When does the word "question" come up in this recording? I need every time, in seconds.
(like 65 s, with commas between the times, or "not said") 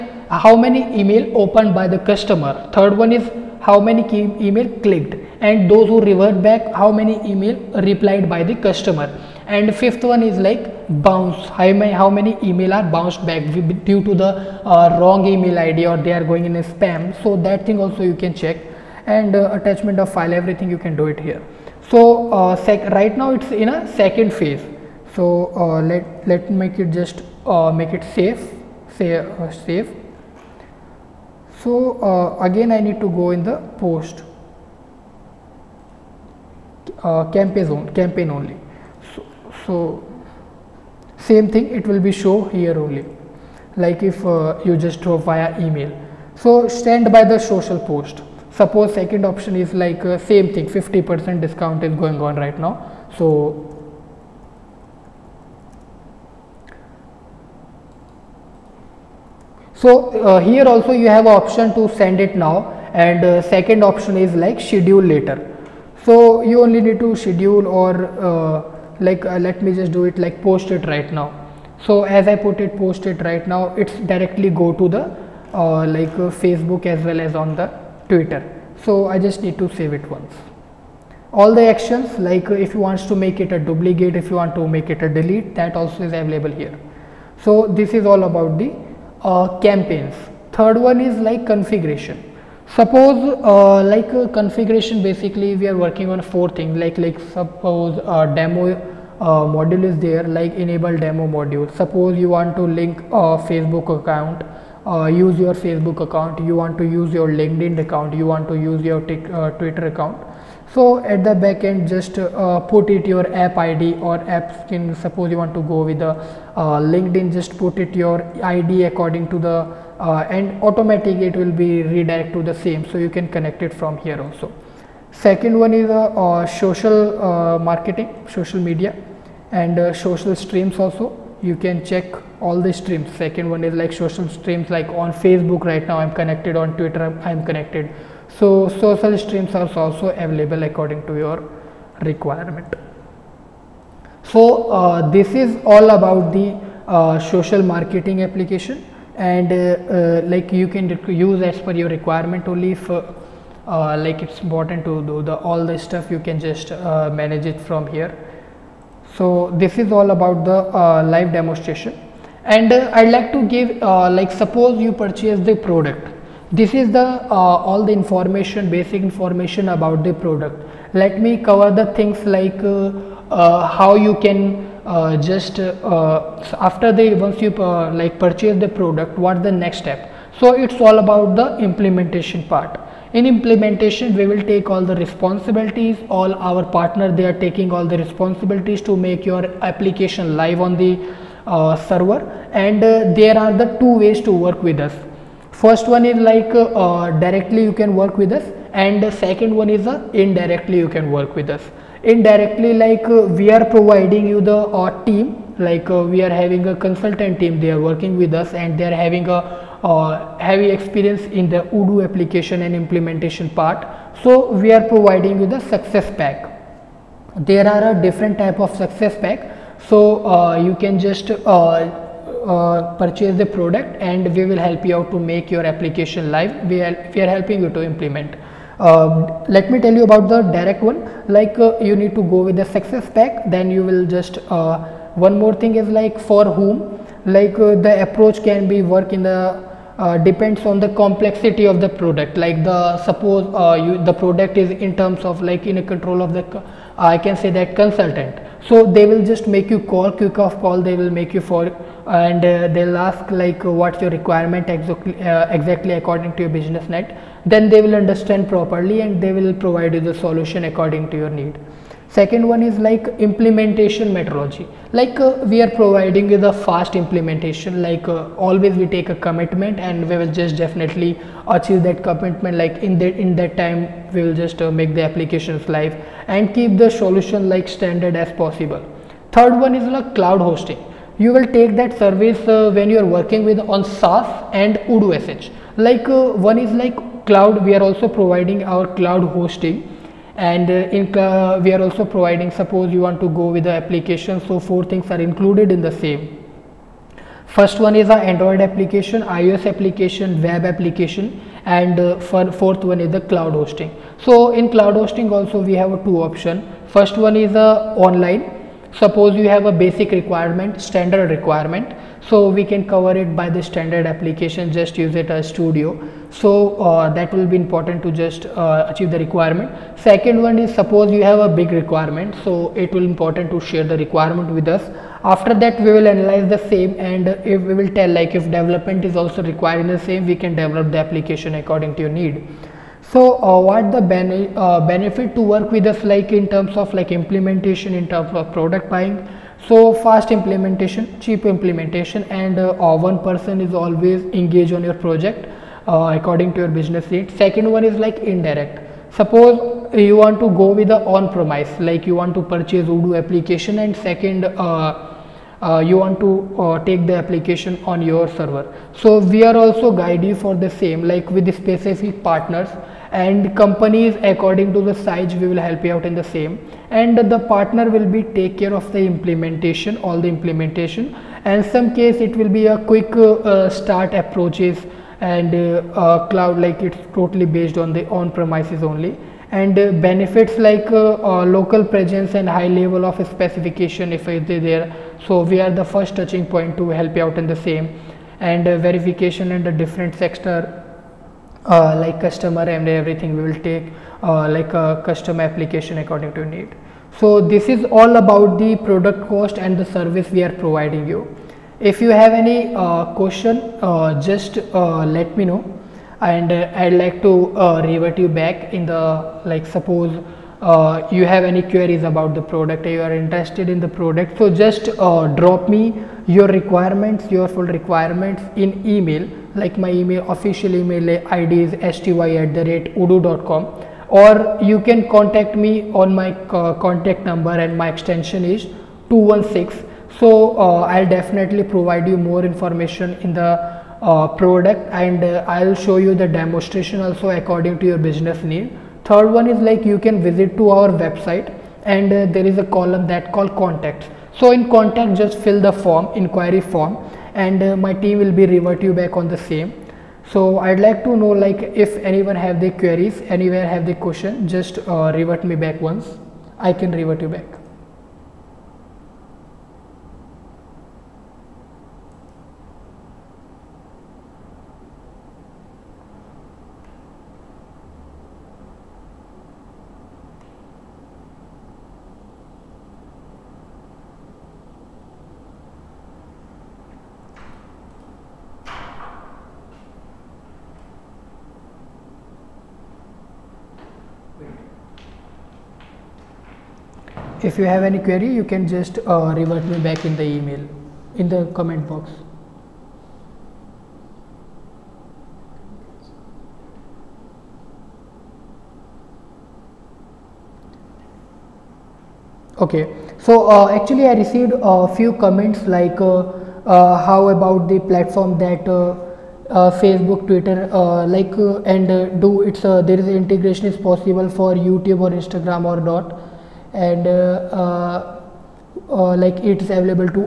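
403 s, 454 s.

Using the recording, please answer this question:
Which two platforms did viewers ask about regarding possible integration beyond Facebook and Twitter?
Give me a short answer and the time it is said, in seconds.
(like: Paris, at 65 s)
YouTube or Instagram, at 514 s.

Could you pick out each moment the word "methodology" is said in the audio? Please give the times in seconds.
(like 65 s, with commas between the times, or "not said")
264 s.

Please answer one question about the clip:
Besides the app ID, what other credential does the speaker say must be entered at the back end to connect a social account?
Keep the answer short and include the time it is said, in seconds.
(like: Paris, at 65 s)
app skin, at 114 s.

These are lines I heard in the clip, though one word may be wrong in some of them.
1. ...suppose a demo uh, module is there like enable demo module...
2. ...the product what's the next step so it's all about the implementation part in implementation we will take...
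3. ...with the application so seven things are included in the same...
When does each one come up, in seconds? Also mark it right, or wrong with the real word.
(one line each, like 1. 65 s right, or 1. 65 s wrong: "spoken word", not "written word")
1. 97 s right
2. 178 s right
3. 293 s wrong: "four", not "seven".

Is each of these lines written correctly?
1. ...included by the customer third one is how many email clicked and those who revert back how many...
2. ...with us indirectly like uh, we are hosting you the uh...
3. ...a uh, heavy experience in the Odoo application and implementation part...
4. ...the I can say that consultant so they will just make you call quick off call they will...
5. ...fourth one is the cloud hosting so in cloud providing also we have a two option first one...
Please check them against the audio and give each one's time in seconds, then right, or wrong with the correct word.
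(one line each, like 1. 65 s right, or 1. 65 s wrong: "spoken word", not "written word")
1. 1 s wrong: "opened", not "included"
2. 201 s wrong: "providing", not "hosting"
3. 209 s right
4. 246 s right
5. 302 s wrong: "hosting", not "providing".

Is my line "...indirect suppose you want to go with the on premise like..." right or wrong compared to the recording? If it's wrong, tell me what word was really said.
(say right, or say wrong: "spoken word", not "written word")
right.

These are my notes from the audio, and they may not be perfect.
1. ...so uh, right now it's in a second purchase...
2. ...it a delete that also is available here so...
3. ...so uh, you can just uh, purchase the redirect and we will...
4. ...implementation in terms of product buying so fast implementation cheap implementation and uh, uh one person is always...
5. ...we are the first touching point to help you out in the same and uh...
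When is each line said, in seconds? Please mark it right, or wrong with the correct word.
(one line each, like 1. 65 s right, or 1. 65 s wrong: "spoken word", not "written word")
1. 21 s wrong: "phase", not "purchase"
2. 84 s right
3. 219 s wrong: "product", not "redirect"
4. 337 s right
5. 385 s right.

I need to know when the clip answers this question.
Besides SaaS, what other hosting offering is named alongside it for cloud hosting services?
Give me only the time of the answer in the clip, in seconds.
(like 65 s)
284 s.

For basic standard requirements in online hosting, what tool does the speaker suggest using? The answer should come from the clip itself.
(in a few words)
studio.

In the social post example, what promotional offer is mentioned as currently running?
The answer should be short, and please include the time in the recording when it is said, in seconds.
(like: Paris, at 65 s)
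50 percent discount, at 50 s.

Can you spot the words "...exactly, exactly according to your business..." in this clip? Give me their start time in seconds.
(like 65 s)
254 s.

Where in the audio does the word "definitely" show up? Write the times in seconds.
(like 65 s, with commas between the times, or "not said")
270 s, 431 s.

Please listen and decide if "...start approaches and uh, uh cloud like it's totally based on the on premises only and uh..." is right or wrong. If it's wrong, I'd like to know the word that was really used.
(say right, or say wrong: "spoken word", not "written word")
right.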